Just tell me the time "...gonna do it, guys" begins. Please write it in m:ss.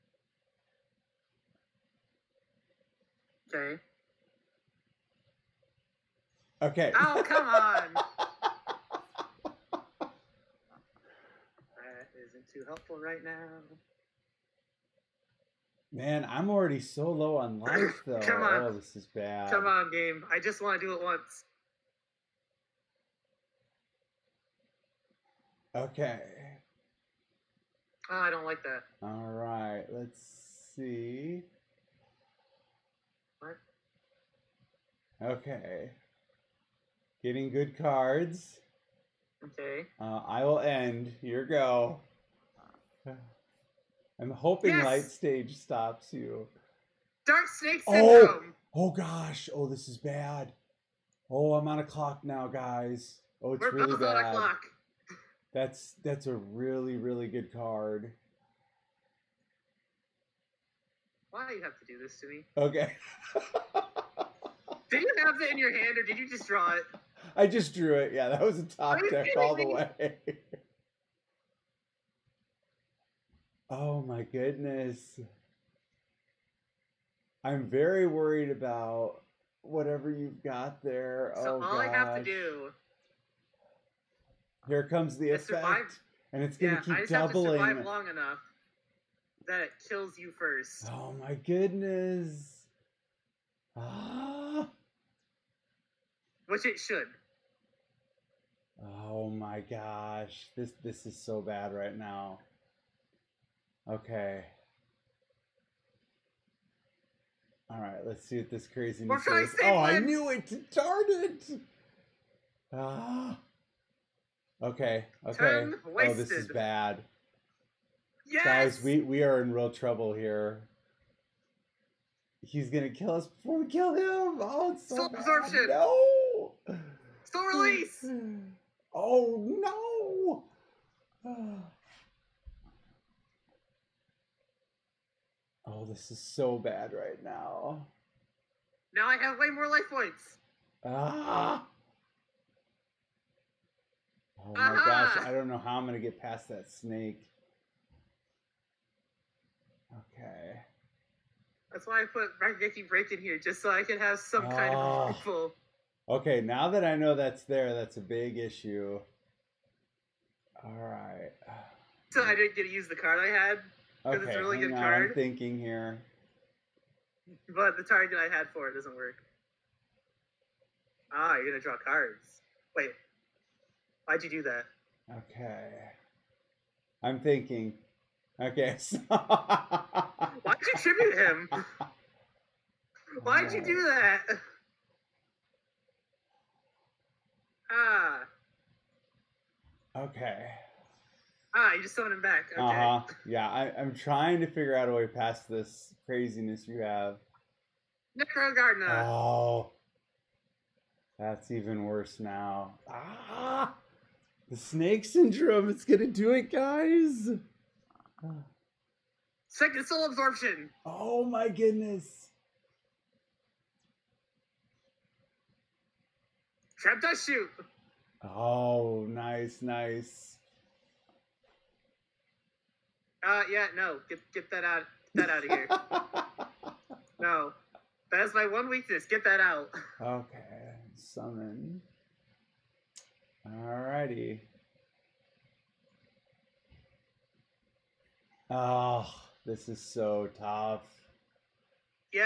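3:25.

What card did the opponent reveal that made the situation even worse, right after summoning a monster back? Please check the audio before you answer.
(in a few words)
Necro Gardna.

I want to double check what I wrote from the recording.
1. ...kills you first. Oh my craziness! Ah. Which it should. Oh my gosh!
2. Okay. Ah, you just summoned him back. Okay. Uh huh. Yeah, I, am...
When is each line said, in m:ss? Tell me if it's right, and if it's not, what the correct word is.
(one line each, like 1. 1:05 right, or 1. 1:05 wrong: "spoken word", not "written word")
1. 1:29 wrong: "goodness", not "craziness"
2. 3:09 right.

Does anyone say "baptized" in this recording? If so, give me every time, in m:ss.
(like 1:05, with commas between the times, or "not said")
not said.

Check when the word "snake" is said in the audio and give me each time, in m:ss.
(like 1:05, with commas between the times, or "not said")
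0:47, 2:26, 3:24.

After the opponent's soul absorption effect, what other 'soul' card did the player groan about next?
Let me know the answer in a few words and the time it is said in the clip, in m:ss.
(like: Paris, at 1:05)
Soul Release, at 2:07.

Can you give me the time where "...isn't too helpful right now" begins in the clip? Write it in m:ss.
0:12.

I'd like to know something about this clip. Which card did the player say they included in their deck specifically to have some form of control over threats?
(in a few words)
Raigeki Break.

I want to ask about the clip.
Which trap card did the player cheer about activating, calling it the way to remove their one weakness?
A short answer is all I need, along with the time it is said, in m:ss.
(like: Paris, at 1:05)
Dustshoot, at 3:36.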